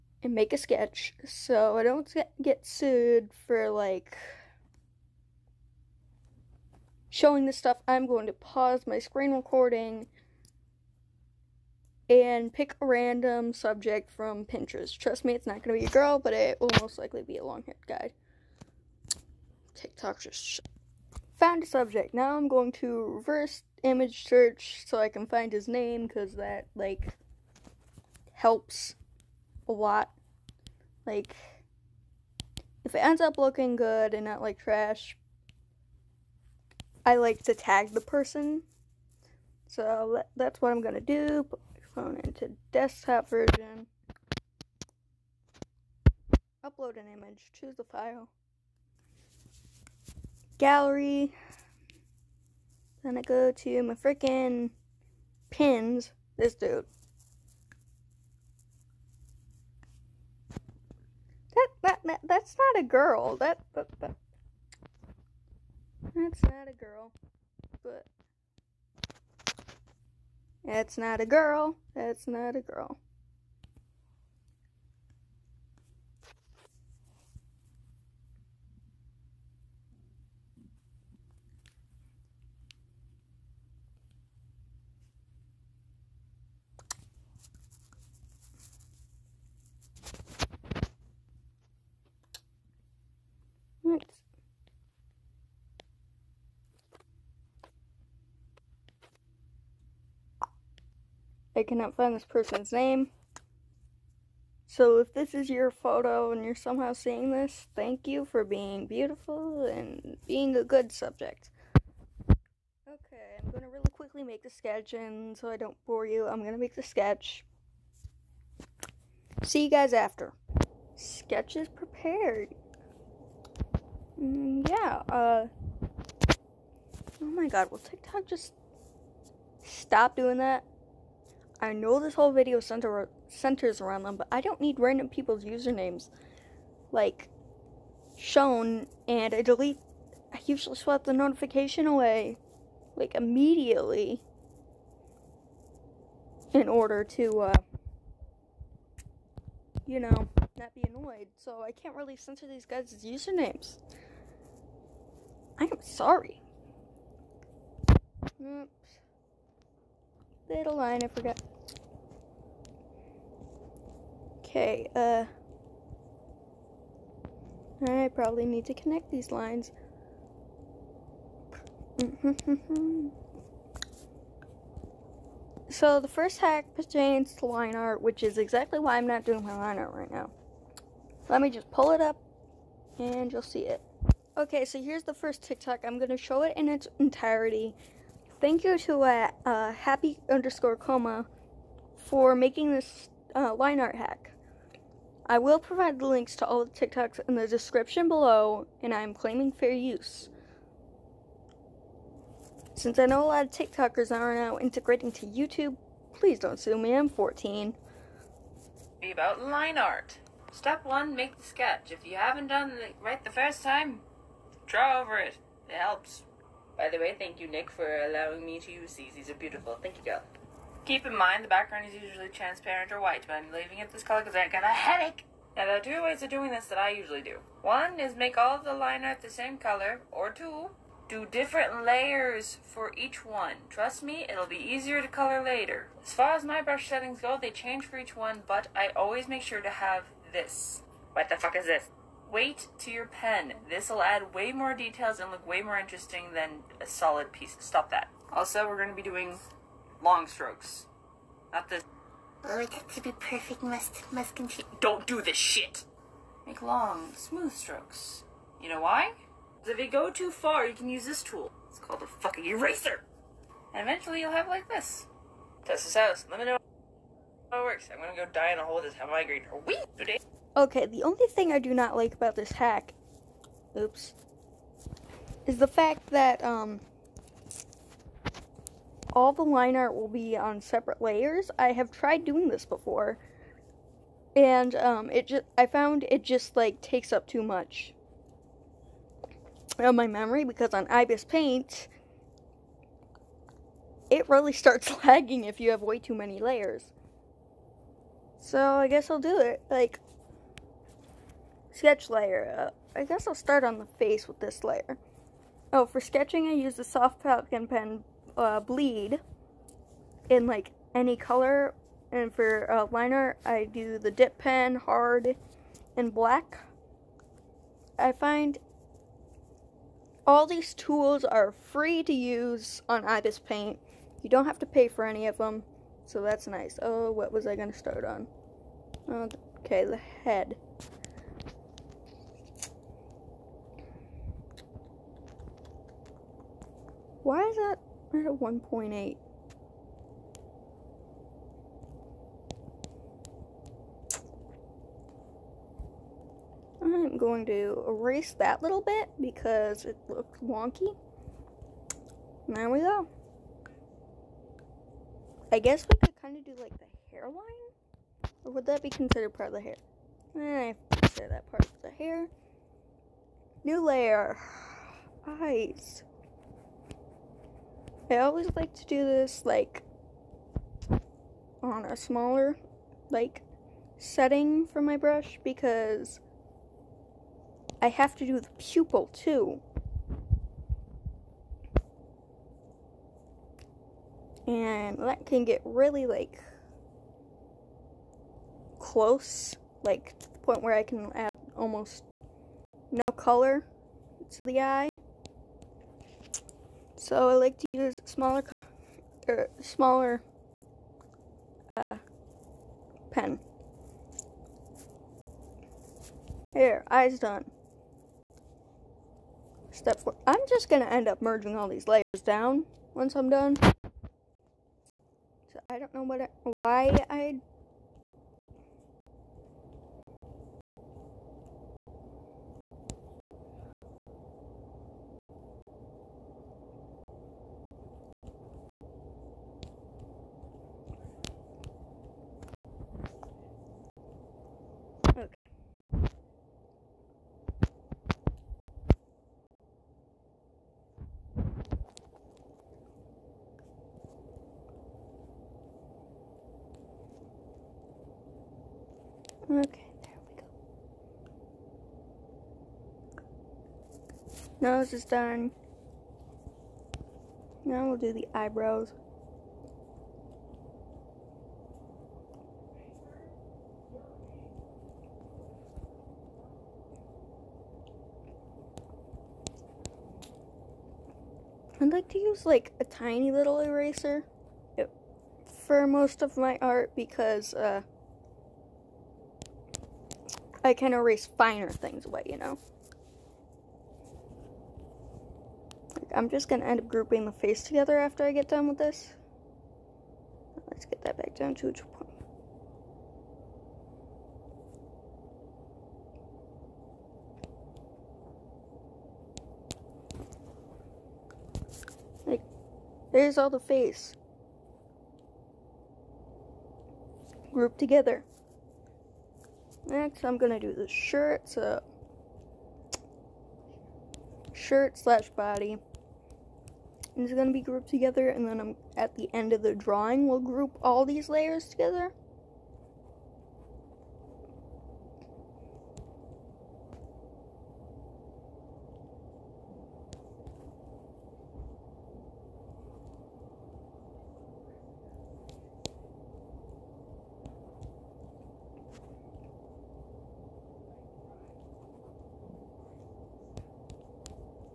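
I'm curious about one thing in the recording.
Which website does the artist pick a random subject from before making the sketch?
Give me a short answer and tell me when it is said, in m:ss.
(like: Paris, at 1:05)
Pinterest, at 0:14.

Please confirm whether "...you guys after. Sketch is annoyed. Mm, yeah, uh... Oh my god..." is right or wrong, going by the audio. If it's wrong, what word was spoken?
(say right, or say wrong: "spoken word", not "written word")
wrong: "prepared", not "annoyed".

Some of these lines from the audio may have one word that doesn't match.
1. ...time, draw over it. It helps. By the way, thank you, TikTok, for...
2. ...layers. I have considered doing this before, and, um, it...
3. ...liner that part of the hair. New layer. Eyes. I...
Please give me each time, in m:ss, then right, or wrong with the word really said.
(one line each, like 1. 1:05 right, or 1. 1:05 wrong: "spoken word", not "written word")
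1. 3:33 wrong: "Nick", not "TikTok"
2. 4:41 wrong: "tried", not "considered"
3. 6:00 wrong: "consider", not "liner".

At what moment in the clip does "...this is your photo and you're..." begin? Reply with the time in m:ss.
1:45.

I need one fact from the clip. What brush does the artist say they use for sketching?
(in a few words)
Soft Falcon pen.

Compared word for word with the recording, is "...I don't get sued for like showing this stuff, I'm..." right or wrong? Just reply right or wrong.
right.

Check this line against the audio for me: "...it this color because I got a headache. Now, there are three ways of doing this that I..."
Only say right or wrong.
wrong.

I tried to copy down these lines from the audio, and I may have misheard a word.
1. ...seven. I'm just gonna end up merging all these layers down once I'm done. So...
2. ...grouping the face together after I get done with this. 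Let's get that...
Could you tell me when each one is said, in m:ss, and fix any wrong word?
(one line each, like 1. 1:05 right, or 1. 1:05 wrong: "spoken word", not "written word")
1. 6:50 wrong: "four", not "seven"
2. 8:06 right.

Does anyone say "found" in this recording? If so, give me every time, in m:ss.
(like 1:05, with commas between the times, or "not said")
0:21, 4:45.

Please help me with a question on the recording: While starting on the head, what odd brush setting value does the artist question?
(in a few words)
1.8.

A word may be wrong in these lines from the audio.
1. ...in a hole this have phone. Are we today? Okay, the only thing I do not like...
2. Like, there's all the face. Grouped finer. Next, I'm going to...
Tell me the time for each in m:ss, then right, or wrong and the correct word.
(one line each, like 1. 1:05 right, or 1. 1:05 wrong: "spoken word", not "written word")
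1. 4:28 wrong: "migraine", not "phone"
2. 8:22 wrong: "together", not "finer".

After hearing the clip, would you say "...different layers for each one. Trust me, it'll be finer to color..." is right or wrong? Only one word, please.
wrong.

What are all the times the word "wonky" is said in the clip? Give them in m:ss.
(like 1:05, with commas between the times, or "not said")
5:50.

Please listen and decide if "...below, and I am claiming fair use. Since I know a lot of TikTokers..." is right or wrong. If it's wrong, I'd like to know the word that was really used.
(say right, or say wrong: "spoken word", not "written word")
right.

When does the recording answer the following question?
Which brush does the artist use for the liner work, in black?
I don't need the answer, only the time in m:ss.
5:14.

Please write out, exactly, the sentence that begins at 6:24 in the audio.
And that can get really like close, like to the point where I can add almost no color to the eye.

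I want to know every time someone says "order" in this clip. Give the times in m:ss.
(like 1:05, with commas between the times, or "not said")
2:26.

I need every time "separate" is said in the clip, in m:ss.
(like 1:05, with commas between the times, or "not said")
4:40.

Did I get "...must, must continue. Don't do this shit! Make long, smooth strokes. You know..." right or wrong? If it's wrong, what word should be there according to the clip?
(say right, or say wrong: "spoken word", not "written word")
right.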